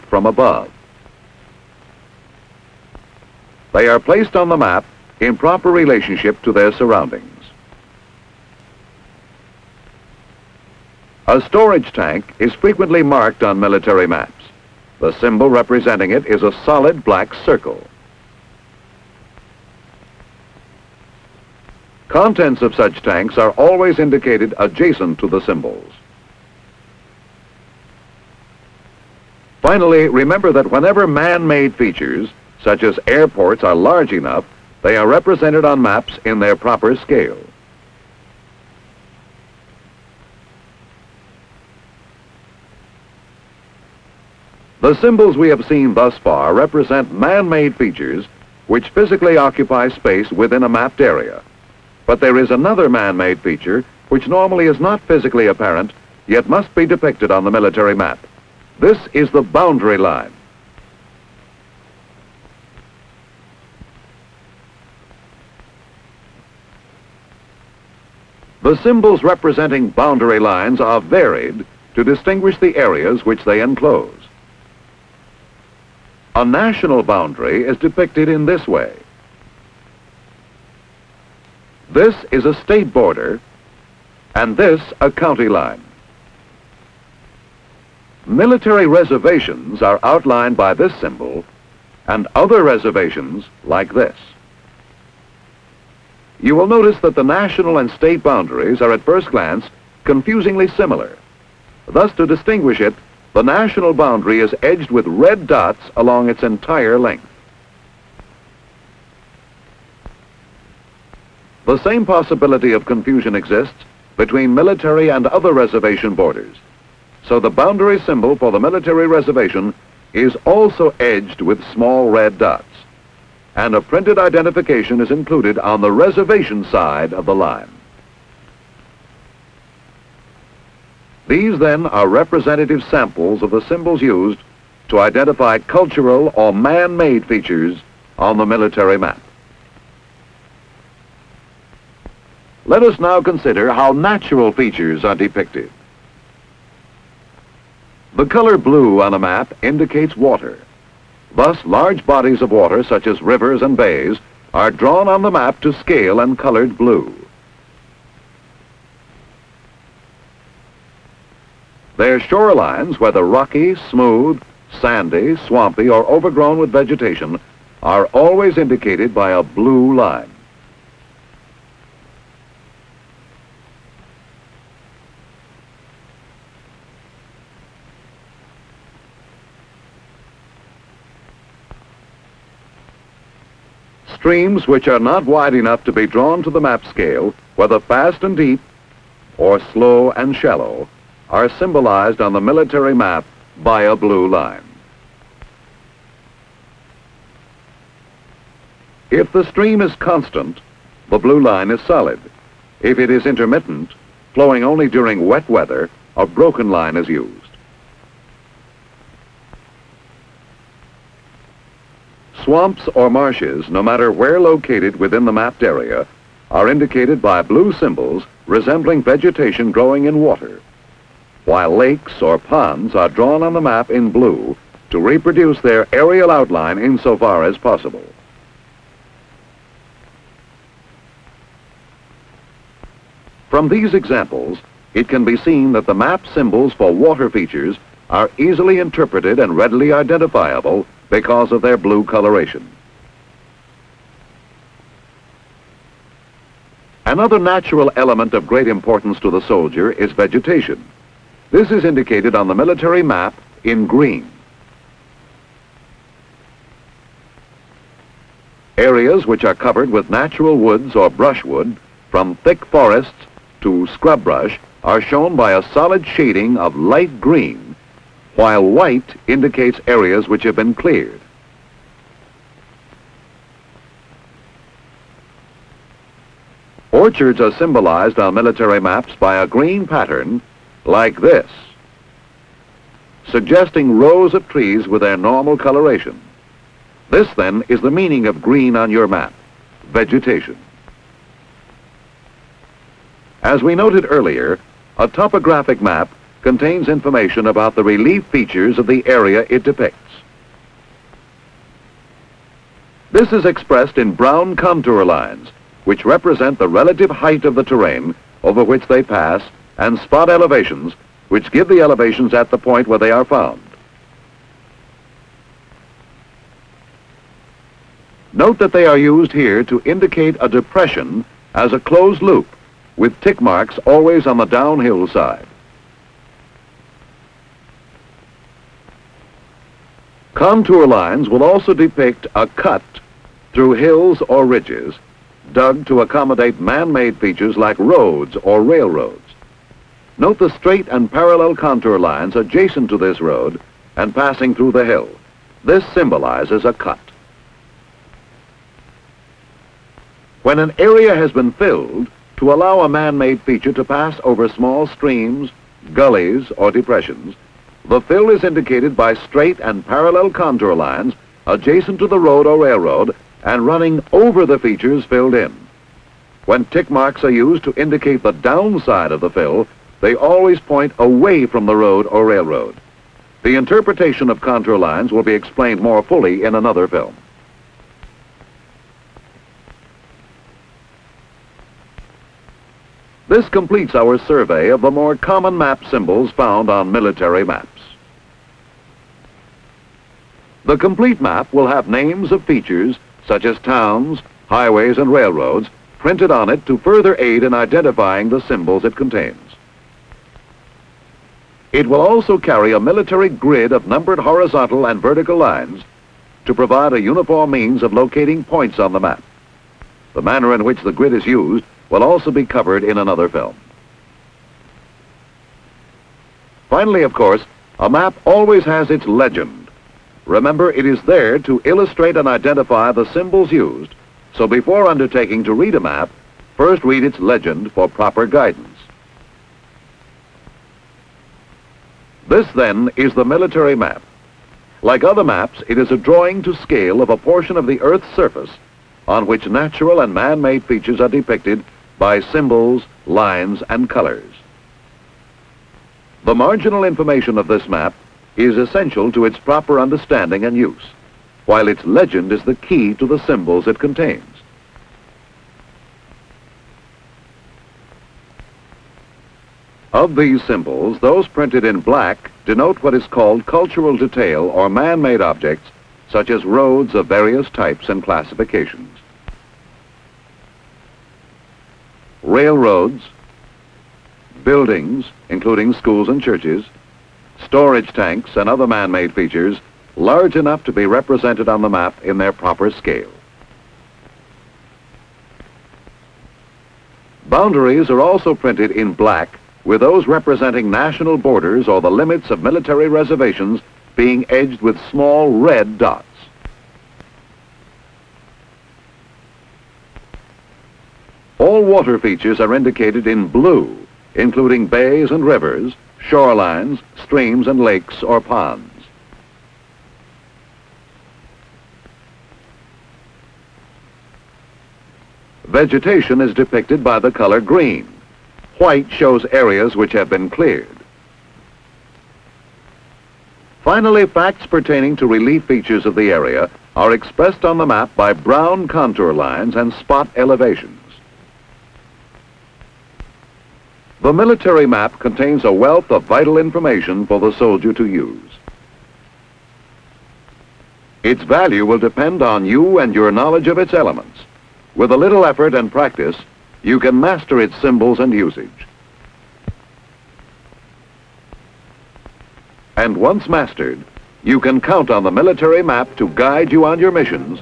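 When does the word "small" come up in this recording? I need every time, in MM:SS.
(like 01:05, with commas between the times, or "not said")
02:01, 05:54, 08:14.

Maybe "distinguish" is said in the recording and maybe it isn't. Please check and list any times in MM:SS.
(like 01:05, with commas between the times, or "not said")
01:12, 01:42.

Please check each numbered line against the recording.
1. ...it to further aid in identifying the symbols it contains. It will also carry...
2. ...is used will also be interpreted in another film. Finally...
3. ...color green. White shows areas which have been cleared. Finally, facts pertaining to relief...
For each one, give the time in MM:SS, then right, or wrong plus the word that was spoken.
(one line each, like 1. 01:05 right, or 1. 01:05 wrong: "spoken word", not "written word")
1. 06:36 right
2. 06:51 wrong: "covered", not "interpreted"
3. 08:37 right.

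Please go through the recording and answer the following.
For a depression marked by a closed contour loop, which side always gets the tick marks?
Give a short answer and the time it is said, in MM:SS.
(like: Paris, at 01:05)
Downhill side, at 05:24.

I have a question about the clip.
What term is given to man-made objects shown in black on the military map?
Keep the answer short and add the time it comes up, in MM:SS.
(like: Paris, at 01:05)
Cultural detail, at 07:43.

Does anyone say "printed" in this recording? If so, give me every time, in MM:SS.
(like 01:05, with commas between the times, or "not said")
02:03, 06:35, 07:41, 08:08.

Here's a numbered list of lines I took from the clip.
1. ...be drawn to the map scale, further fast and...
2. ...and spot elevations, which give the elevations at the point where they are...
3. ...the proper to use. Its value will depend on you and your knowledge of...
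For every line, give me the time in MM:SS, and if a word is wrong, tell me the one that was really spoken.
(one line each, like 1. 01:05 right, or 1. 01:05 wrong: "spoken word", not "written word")
1. 03:05 wrong: "whether", not "further"
2. 05:09 right
3. 08:57 wrong: "soldier", not "proper".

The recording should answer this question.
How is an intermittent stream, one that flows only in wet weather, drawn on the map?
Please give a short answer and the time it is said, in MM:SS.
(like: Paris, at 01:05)
Broken line, at 03:26.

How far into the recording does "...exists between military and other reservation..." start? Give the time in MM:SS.
01:53.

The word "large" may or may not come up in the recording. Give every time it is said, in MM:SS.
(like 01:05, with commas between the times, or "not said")
00:33, 02:31, 07:59.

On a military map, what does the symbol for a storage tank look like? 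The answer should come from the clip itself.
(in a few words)
Solid black circle.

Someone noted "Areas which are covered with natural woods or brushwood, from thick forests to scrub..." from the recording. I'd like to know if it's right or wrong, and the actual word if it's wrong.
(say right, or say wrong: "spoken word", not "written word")
right.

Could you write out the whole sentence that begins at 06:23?
This completes our survey of the more common map symbols found on military maps.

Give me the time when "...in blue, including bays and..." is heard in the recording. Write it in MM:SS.
08:23.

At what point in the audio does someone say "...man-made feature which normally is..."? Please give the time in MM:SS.
00:52.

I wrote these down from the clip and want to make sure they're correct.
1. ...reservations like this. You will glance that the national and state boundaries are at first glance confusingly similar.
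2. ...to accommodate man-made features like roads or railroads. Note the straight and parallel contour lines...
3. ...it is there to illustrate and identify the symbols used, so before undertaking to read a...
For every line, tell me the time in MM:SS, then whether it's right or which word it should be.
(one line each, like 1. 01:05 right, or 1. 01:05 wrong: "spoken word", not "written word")
1. 01:32 wrong: "notice", not "glance"
2. 05:35 right
3. 07:00 right.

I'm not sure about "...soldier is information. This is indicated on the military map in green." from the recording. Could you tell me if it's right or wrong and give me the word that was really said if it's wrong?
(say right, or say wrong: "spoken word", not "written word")
wrong: "vegetation", not "information".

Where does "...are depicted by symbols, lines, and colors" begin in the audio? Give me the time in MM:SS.
07:20.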